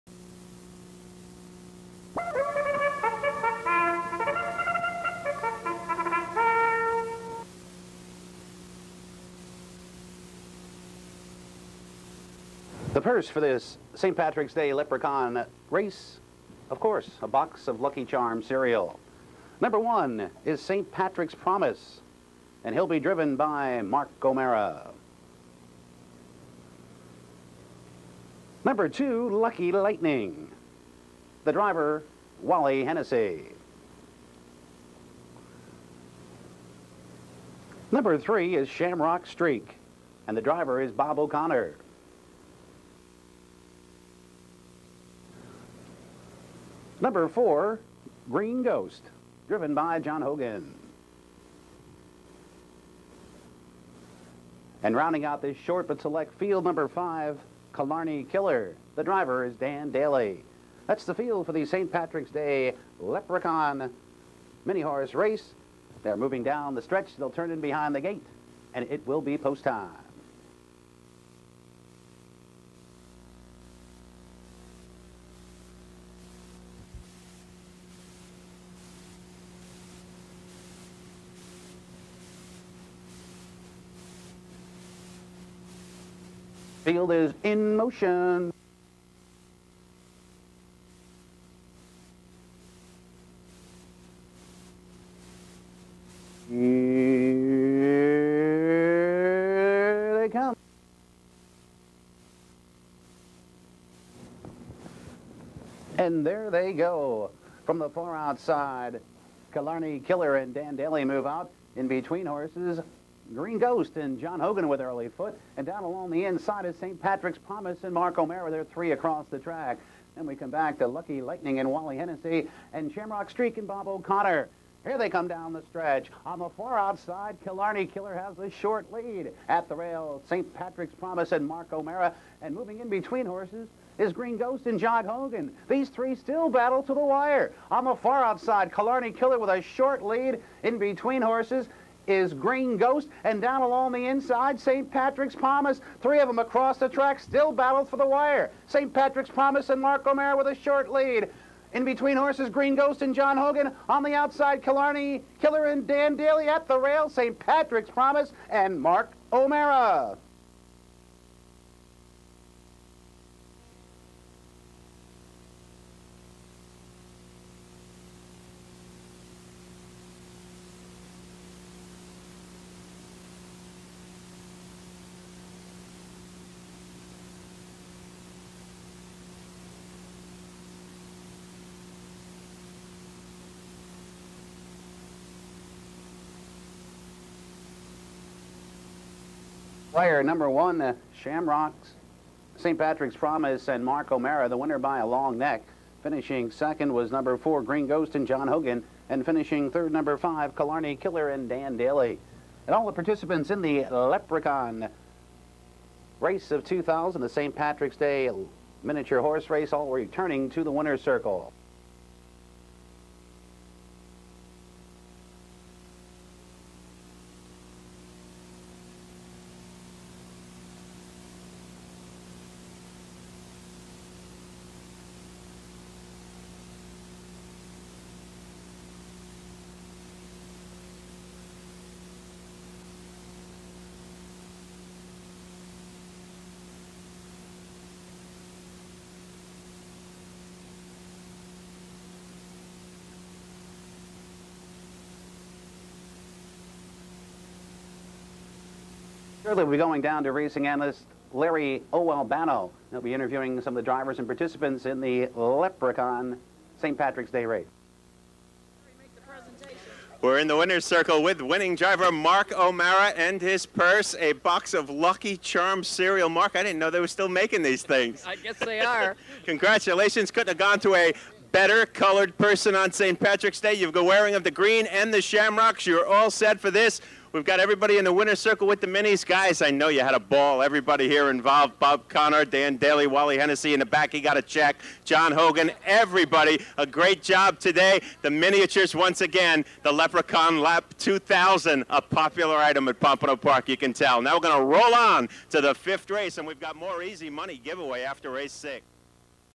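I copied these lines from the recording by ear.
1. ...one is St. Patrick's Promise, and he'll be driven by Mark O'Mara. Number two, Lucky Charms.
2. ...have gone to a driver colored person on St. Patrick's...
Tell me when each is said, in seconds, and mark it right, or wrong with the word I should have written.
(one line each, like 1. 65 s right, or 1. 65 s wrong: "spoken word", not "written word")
1. 19 s wrong: "Lightning", not "Charms"
2. 270 s wrong: "better", not "driver".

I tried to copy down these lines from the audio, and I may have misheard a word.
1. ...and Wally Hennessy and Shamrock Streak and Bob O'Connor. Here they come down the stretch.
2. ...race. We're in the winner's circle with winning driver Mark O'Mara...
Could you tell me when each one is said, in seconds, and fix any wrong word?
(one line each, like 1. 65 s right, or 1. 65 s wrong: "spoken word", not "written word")
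1. 121 s right
2. 257 s right.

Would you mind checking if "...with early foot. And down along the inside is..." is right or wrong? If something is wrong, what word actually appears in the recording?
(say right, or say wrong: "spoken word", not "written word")
right.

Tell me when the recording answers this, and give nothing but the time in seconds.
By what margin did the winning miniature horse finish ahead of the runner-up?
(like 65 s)
194 s.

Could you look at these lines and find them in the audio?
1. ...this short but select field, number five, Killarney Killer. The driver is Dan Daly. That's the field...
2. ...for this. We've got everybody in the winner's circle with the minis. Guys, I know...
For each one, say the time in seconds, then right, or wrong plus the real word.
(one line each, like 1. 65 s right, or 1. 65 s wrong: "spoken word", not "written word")
1. 55 s right
2. 276 s right.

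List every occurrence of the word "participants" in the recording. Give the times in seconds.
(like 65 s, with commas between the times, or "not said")
202 s, 254 s.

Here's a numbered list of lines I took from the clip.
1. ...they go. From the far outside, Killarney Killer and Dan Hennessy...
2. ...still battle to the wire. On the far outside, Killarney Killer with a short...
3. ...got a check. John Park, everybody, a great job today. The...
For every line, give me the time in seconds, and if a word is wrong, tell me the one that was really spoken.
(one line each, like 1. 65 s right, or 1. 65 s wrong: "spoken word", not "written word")
1. 106 s wrong: "Daly", not "Hennessy"
2. 136 s right
3. 284 s wrong: "Hogan", not "Park".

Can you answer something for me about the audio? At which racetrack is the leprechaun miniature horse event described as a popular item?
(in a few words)
Pompano Park.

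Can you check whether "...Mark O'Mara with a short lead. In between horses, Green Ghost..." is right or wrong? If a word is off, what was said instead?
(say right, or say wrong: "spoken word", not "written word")
right.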